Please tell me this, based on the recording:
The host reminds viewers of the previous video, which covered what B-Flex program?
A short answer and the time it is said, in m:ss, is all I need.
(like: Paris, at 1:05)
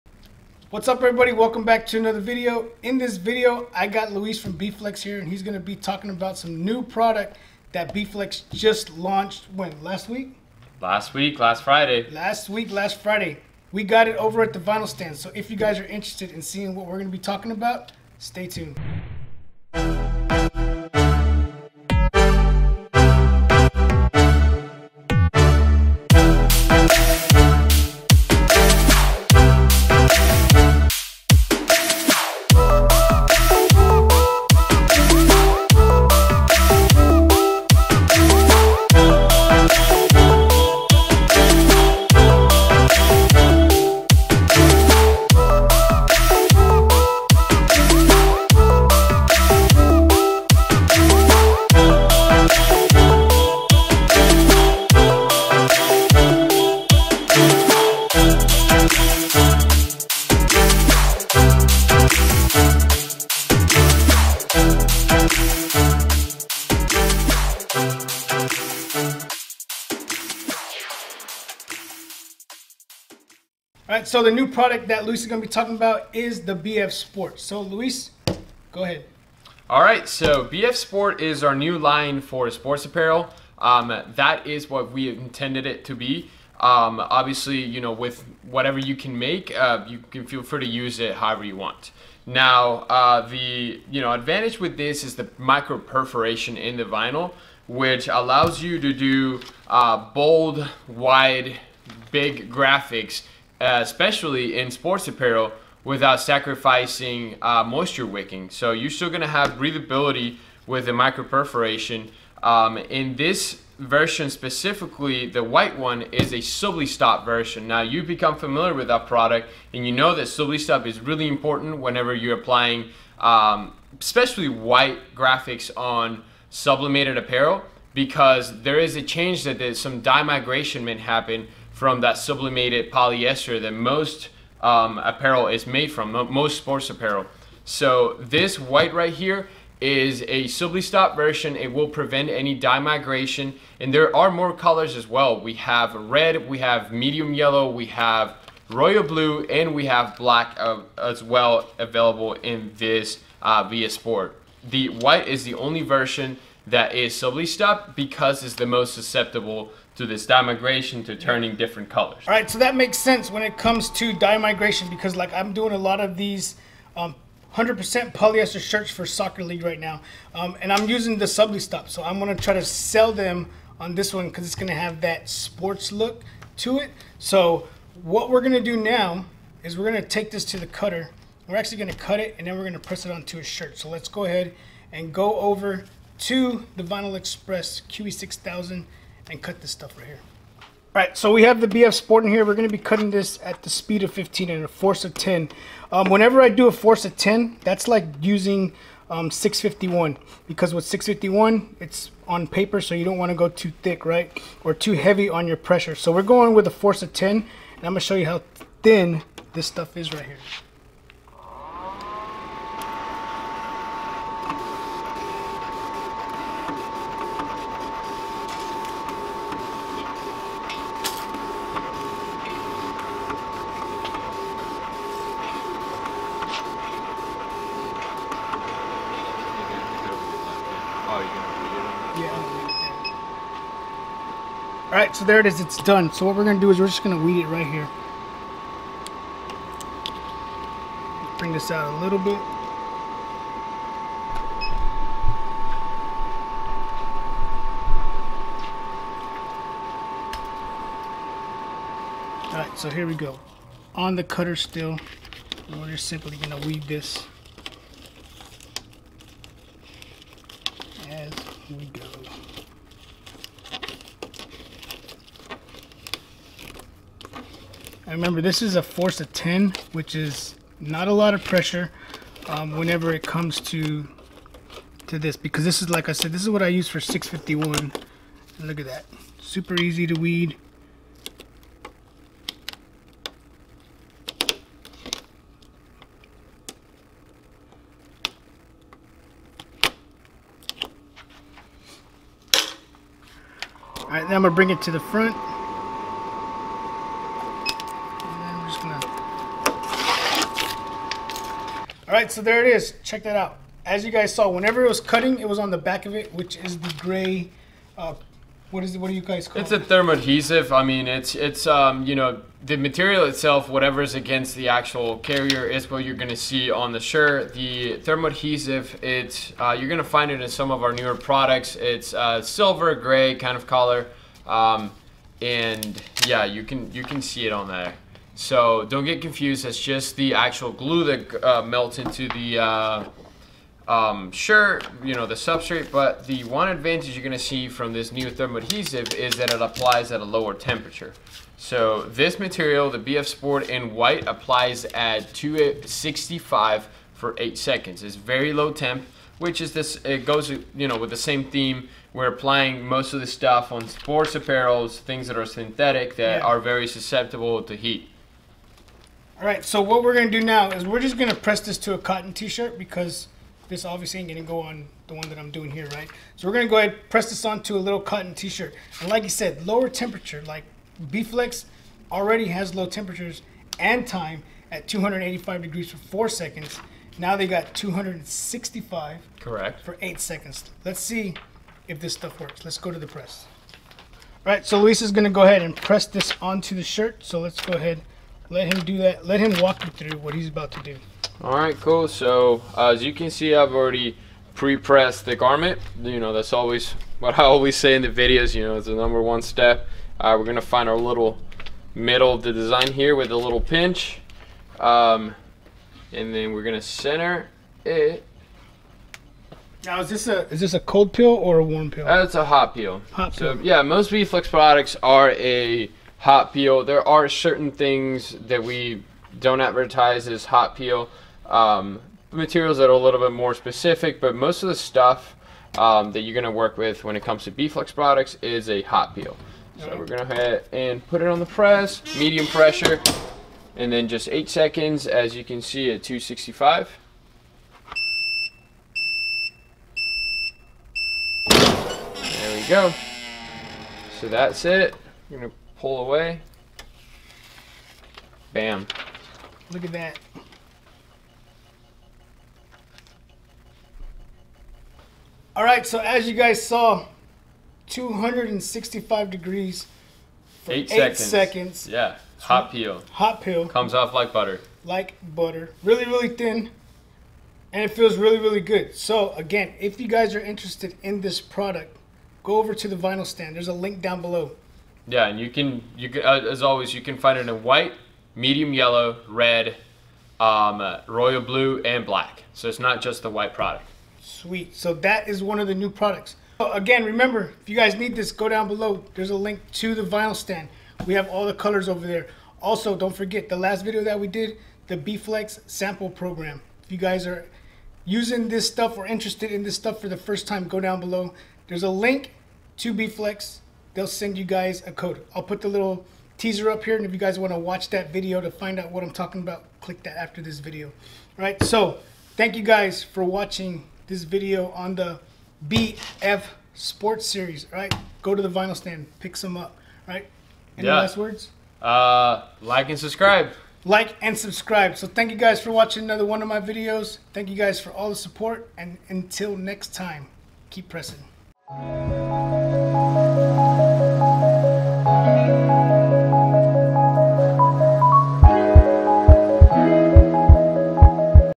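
sample program, at 8:14.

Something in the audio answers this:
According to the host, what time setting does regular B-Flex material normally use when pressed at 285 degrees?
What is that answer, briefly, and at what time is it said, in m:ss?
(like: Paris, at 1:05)
4 seconds, at 6:15.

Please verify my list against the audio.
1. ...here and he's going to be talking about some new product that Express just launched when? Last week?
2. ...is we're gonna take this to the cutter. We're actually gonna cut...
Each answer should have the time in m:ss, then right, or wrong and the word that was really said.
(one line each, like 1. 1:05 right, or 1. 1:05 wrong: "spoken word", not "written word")
1. 0:04 wrong: "Bflex", not "Express"
2. 2:59 right.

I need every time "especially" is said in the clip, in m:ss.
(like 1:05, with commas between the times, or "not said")
1:43, 2:03.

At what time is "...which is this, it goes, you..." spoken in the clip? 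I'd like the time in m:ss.
5:49.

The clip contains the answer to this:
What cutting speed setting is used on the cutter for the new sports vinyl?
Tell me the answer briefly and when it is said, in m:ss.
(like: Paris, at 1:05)
15, at 3:13.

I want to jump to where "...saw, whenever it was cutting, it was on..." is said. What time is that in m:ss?
5:04.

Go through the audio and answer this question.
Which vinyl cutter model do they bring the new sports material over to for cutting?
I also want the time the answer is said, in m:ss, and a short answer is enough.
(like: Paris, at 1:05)
Vinyl Express QE6000, at 3:06.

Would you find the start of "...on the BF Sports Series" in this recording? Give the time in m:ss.
8:34.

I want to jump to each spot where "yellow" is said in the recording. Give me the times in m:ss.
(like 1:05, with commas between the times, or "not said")
2:27, 7:58.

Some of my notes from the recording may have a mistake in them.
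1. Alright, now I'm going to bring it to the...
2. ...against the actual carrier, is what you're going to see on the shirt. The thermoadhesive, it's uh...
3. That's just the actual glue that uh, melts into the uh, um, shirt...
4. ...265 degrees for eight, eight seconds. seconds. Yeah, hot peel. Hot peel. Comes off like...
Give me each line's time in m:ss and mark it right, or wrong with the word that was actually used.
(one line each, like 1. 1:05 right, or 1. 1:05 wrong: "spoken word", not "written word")
1. 4:54 right
2. 5:14 right
3. 5:29 right
4. 7:37 right.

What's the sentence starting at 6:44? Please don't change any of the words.
Um, and then we're gonna center it.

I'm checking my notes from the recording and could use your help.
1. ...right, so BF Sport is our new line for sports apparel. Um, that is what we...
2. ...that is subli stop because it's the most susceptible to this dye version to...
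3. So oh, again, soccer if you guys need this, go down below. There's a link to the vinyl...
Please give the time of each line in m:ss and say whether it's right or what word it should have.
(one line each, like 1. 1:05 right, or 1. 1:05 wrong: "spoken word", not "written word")
1. 1:19 right
2. 2:36 wrong: "migration", not "version"
3. 8:06 wrong: "remember", not "soccer".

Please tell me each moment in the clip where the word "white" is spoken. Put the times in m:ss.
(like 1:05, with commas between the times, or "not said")
1:55, 2:04, 2:18, 2:34, 5:43, 7:57, 8:03.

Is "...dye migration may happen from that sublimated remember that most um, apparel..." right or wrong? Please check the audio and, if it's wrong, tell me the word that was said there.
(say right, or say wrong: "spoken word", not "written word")
wrong: "polyester", not "remember".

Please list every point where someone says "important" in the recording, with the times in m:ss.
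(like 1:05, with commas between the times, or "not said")
2:01.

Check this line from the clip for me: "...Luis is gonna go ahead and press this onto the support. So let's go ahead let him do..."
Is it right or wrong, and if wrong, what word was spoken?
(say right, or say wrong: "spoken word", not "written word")
wrong: "shirt", not "support".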